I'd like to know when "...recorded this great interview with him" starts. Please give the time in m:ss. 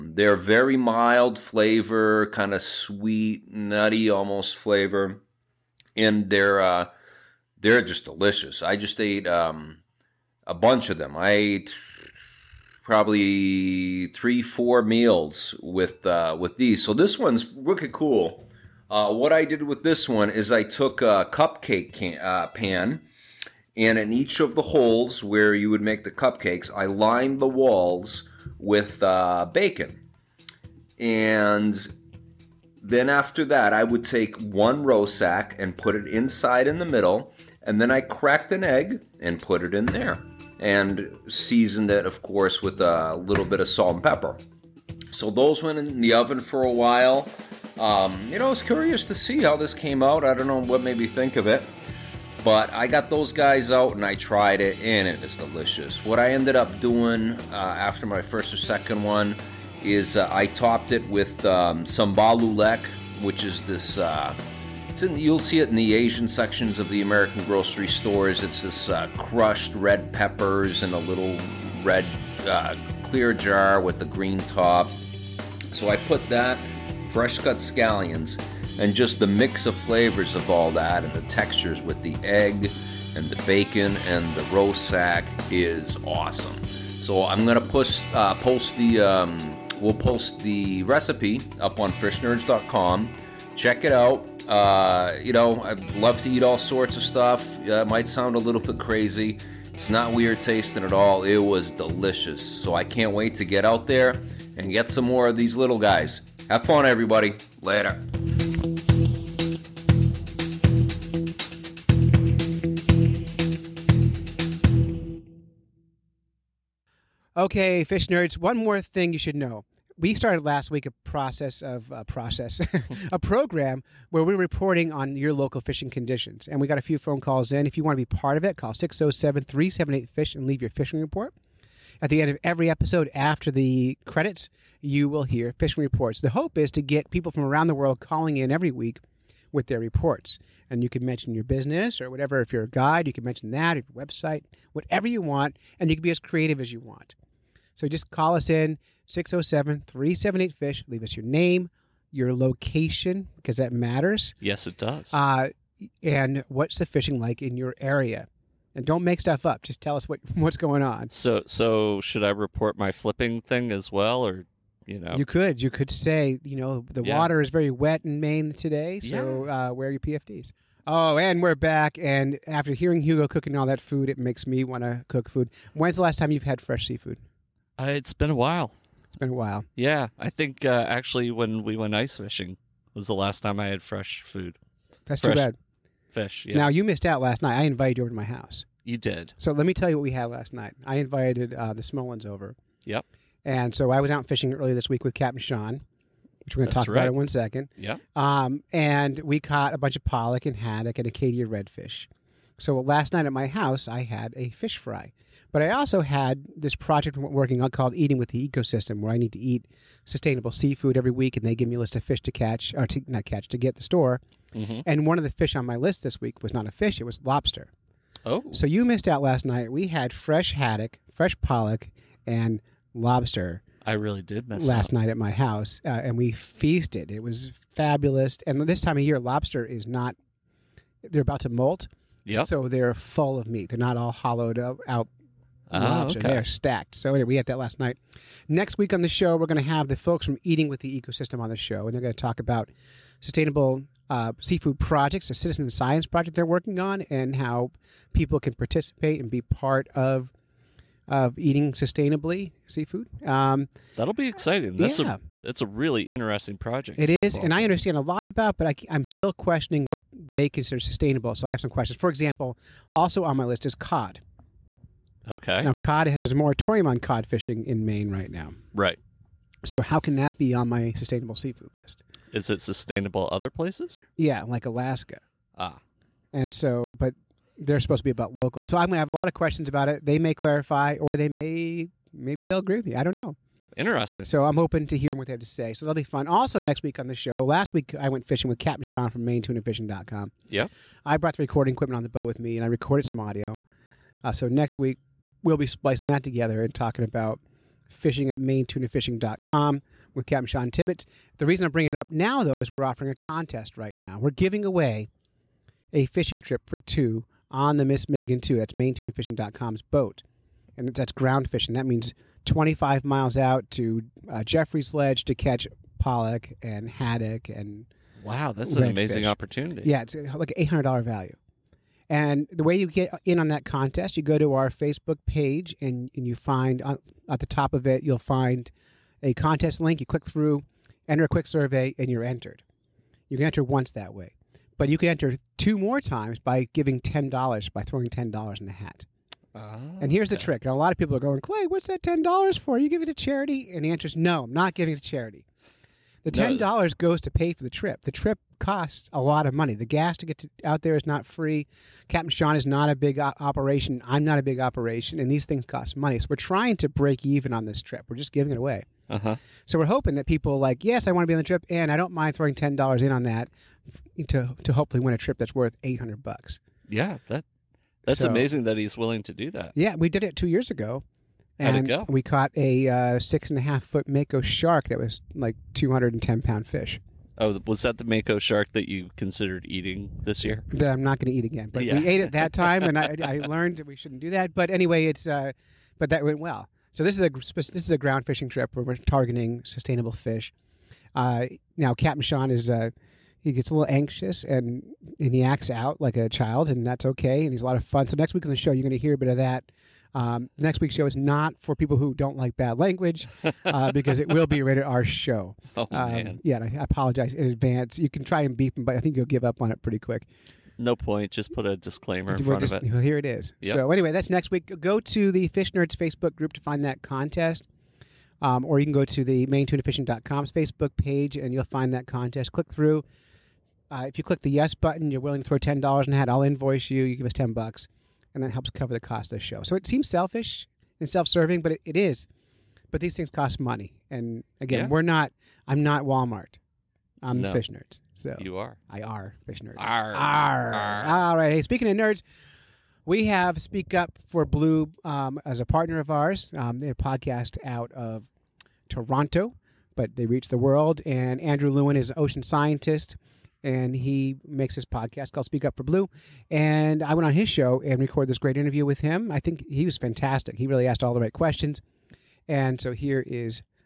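7:37.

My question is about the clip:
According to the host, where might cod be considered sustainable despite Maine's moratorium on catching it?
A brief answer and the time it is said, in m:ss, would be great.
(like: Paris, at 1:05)
Alaska, at 4:34.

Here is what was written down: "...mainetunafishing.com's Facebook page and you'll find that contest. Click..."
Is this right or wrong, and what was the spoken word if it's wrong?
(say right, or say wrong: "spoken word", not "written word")
right.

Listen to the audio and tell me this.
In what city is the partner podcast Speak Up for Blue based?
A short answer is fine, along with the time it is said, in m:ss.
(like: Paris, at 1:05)
Toronto, at 7:28.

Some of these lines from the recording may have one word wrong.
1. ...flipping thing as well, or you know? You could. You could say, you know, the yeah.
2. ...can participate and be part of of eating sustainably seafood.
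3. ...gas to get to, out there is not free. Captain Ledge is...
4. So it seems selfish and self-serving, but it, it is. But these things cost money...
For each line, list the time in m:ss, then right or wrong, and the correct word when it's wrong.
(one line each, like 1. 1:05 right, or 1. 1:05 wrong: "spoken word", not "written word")
1. 2:42 right
2. 4:08 right
3. 5:49 wrong: "Shawn", not "Ledge"
4. 7:09 right.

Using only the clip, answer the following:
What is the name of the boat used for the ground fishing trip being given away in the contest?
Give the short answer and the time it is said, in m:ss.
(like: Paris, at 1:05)
Miss Megan 2, at 5:07.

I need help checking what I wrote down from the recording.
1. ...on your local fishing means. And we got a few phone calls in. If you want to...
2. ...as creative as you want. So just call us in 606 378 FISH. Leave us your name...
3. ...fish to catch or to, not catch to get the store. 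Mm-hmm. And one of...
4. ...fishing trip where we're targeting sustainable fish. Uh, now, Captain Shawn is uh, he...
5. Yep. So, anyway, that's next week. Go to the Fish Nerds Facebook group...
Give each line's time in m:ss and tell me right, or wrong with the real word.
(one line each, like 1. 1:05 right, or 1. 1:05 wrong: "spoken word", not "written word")
1. 2:04 wrong: "conditions", not "means"
2. 2:26 wrong: "607", not "606"
3. 3:32 right
4. 6:28 right
5. 6:53 right.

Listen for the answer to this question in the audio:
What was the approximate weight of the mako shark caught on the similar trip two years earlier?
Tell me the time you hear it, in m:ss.
6:15.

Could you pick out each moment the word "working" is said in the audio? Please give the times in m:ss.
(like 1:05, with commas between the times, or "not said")
3:27, 4:06.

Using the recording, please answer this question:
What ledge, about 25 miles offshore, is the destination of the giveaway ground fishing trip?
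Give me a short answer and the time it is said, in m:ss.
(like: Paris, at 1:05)
Jeffrey's Ledge, at 5:14.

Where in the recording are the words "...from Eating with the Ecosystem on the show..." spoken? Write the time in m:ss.
4:00.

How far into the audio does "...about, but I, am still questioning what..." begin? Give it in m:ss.
4:18.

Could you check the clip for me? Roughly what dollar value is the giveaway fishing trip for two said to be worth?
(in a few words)
$800.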